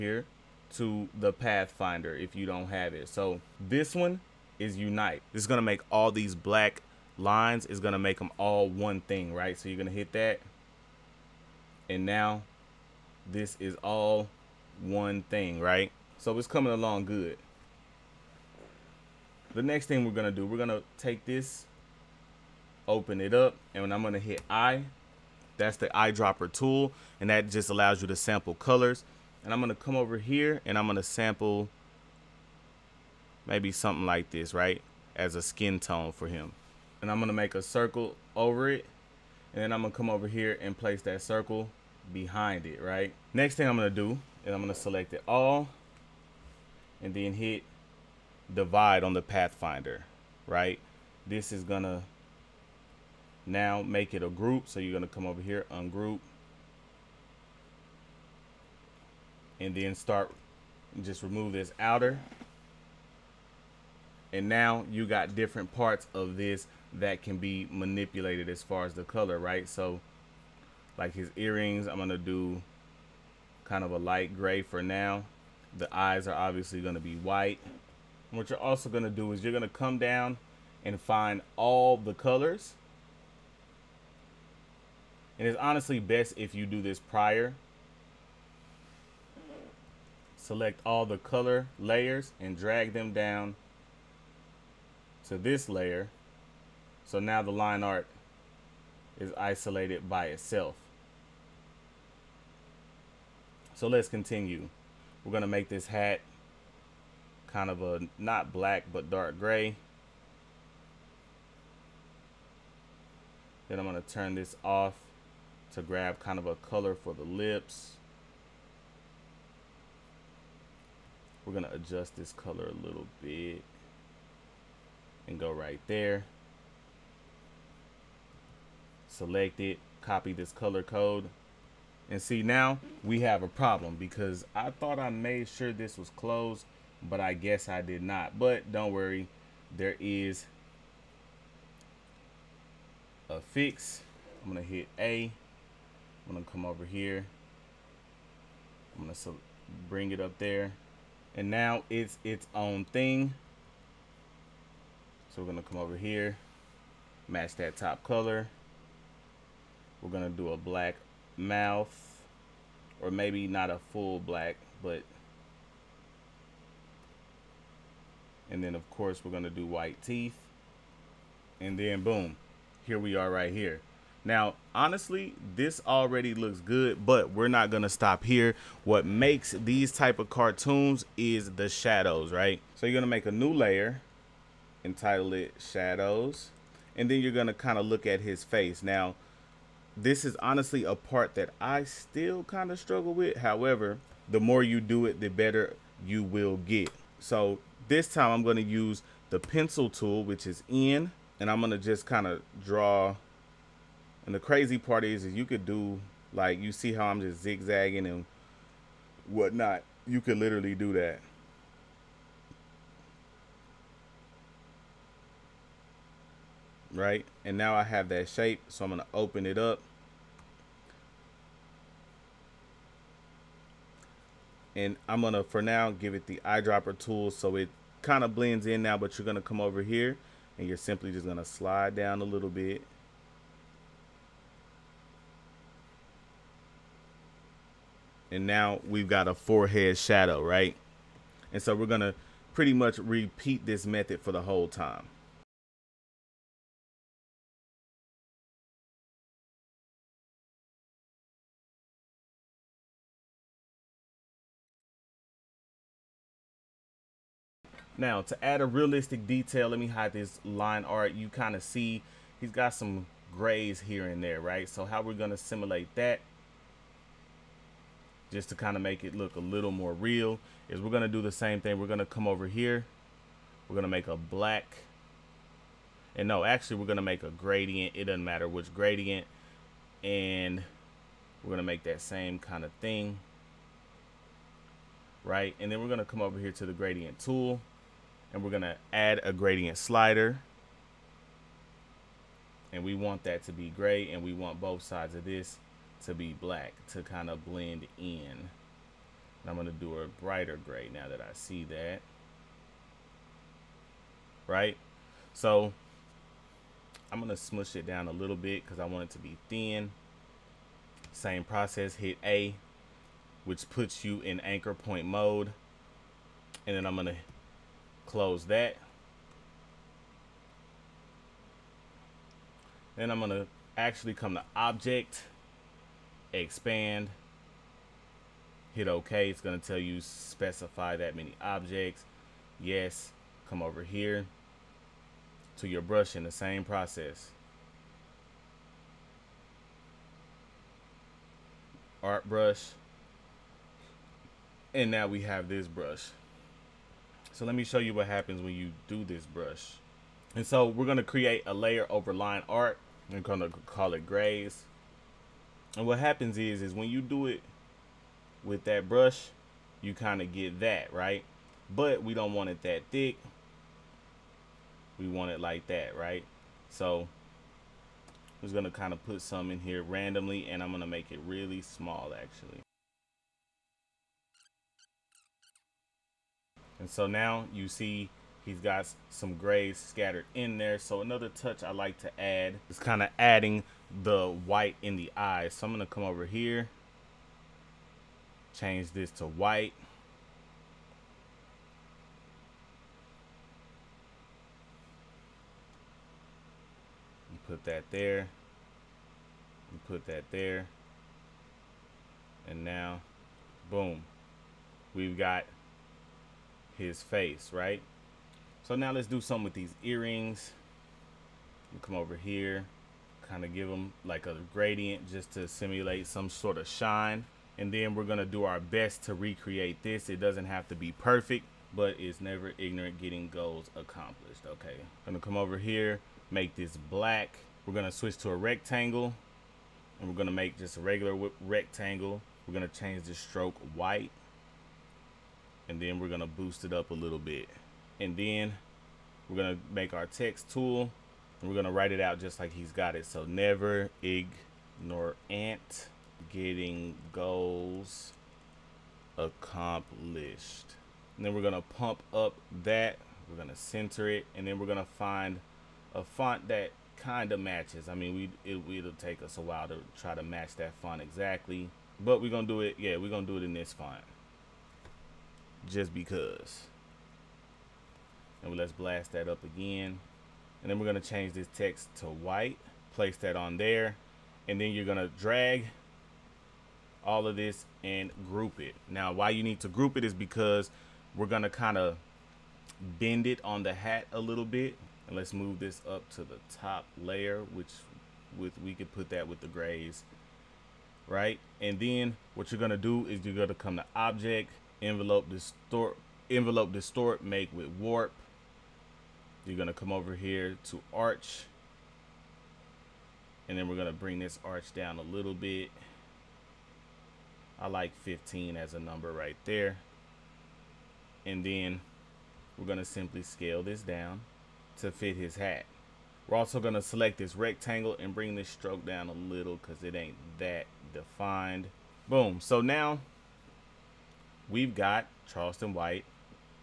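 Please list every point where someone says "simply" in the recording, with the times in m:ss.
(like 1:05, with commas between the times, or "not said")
3:50, 8:32.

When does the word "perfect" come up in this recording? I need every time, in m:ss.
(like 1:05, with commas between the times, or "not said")
7:00.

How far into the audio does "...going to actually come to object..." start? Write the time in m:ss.
5:23.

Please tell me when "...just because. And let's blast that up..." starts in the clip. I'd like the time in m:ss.
7:45.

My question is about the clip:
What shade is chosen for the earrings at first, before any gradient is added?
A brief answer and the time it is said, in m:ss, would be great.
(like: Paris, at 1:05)
light gray, at 1:13.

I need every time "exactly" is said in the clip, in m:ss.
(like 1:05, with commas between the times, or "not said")
7:40.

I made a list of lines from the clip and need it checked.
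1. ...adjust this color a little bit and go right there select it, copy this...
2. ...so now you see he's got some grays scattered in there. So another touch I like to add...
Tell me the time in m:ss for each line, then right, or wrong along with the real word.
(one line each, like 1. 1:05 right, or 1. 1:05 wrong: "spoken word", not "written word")
1. 2:01 right
2. 6:16 right.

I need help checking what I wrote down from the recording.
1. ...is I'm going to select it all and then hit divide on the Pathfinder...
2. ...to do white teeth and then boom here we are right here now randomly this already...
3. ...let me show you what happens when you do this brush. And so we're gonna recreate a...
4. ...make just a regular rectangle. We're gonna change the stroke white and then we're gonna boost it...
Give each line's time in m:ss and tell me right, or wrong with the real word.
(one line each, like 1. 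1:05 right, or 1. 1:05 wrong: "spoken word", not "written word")
1. 0:44 right
2. 2:49 wrong: "honestly", not "randomly"
3. 5:47 wrong: "create", not "recreate"
4. 7:10 right.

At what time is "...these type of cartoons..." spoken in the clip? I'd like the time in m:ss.
2:59.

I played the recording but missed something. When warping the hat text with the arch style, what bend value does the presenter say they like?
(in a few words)
15.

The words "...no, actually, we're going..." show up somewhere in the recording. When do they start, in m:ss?
4:36.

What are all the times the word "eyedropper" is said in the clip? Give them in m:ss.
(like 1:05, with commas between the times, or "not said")
0:25, 3:46.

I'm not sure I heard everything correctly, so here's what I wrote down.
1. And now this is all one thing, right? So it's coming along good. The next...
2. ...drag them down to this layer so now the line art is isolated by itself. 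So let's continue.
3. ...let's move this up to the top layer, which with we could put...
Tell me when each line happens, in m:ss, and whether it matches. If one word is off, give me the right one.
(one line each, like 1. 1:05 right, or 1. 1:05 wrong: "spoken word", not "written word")
1. 0:11 right
2. 1:32 right
3. 8:05 right.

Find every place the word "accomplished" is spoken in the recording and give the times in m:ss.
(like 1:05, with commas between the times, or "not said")
7:03, 7:29.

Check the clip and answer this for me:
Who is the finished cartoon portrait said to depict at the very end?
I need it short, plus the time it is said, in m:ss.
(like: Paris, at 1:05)
Charleston White, at 8:45.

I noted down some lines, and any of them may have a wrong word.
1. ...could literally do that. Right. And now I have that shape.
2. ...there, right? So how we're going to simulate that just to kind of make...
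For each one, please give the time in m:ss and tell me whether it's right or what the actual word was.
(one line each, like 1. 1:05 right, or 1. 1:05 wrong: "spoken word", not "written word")
1. 3:30 right
2. 4:24 right.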